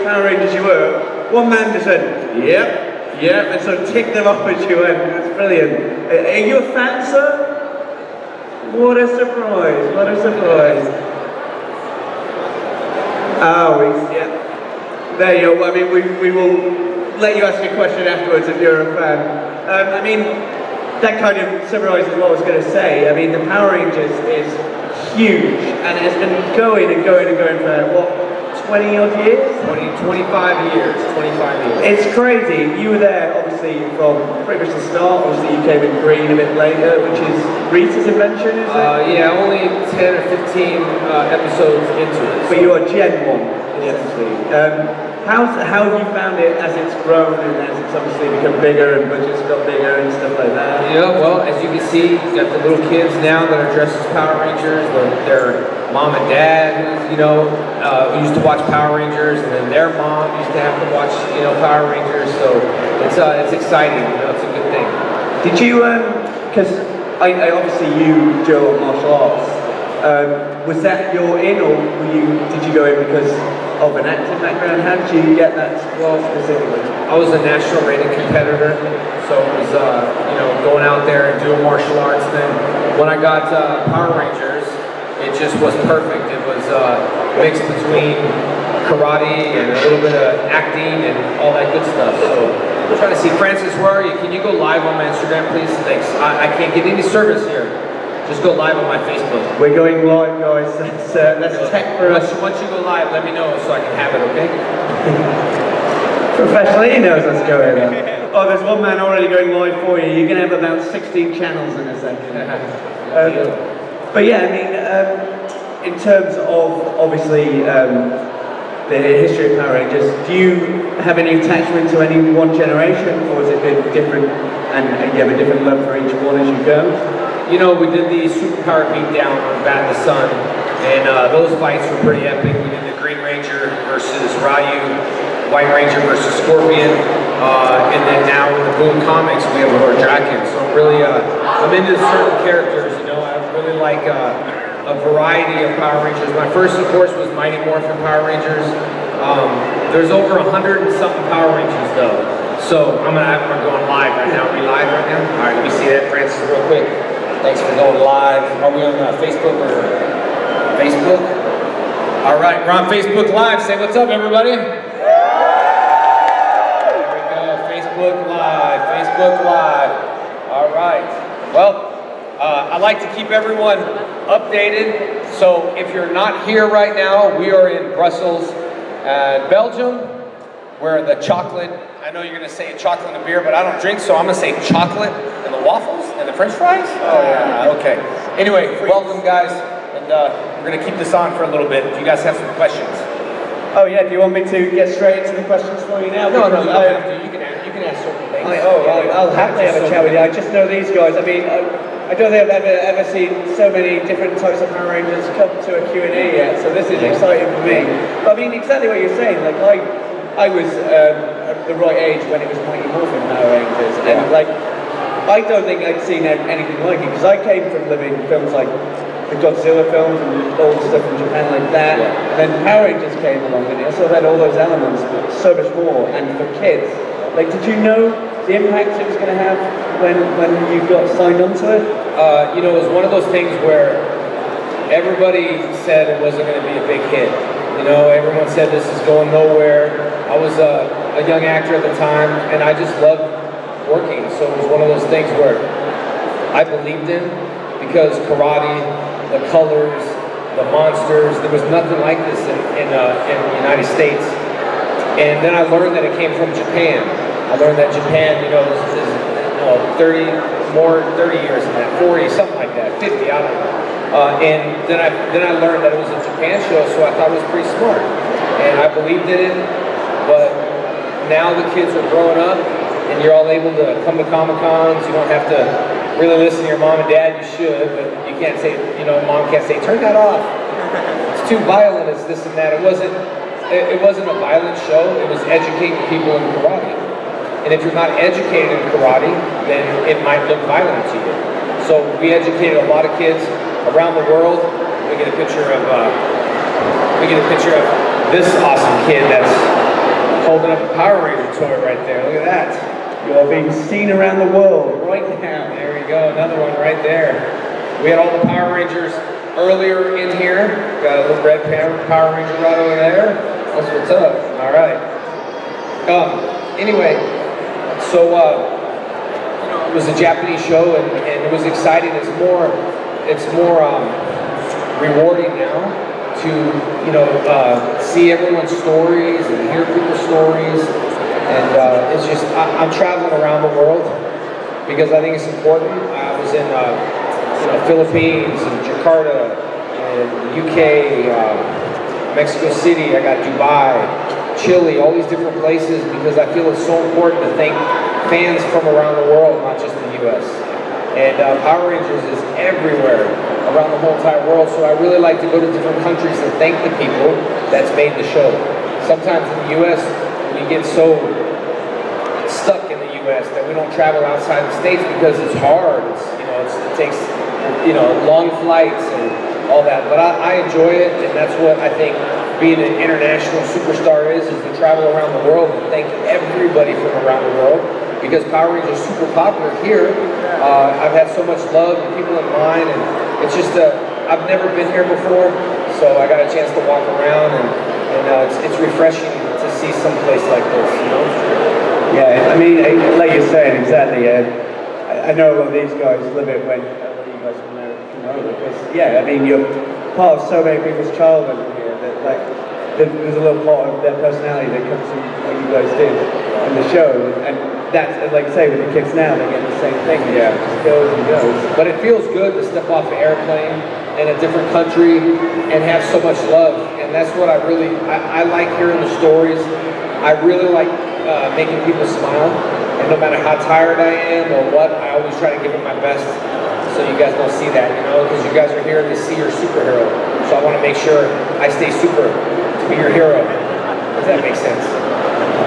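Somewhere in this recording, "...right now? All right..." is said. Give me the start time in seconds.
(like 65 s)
154 s.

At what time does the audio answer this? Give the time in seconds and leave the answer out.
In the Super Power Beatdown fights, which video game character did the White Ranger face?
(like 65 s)
136 s.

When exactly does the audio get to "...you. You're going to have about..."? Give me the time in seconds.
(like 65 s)
109 s.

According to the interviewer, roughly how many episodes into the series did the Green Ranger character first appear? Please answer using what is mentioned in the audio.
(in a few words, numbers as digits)
10 or 15.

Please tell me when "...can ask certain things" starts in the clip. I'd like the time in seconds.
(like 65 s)
197 s.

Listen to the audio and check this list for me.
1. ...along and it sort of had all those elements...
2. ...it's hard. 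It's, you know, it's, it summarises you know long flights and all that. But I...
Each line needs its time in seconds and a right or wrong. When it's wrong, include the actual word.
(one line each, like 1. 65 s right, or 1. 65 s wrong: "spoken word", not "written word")
1. 223 s right
2. 365 s wrong: "takes", not "summarises".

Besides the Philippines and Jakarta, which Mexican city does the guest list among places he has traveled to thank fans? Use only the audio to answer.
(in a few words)
Mexico City.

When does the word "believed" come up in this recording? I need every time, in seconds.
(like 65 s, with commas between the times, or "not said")
246 s, 268 s.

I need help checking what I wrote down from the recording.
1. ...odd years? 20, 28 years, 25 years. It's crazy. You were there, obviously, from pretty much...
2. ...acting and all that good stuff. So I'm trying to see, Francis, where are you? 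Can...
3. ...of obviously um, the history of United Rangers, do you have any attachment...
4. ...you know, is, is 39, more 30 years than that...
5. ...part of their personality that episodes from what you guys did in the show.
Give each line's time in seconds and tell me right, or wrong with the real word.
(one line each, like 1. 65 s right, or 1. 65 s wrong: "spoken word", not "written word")
1. 28 s wrong: "25", not "28"
2. 90 s right
3. 116 s wrong: "Power", not "United"
4. 258 s wrong: "30", not "39"
5. 403 s wrong: "comes", not "episodes".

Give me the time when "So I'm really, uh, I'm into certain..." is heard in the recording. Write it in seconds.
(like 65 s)
140 s.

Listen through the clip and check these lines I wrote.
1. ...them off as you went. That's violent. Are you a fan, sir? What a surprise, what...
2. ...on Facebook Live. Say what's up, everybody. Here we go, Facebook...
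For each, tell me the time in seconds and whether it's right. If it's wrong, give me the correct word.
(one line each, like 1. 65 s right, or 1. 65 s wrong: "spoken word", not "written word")
1. 4 s wrong: "brilliant", not "violent"
2. 162 s right.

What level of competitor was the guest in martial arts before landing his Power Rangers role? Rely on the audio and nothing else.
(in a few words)
national rated.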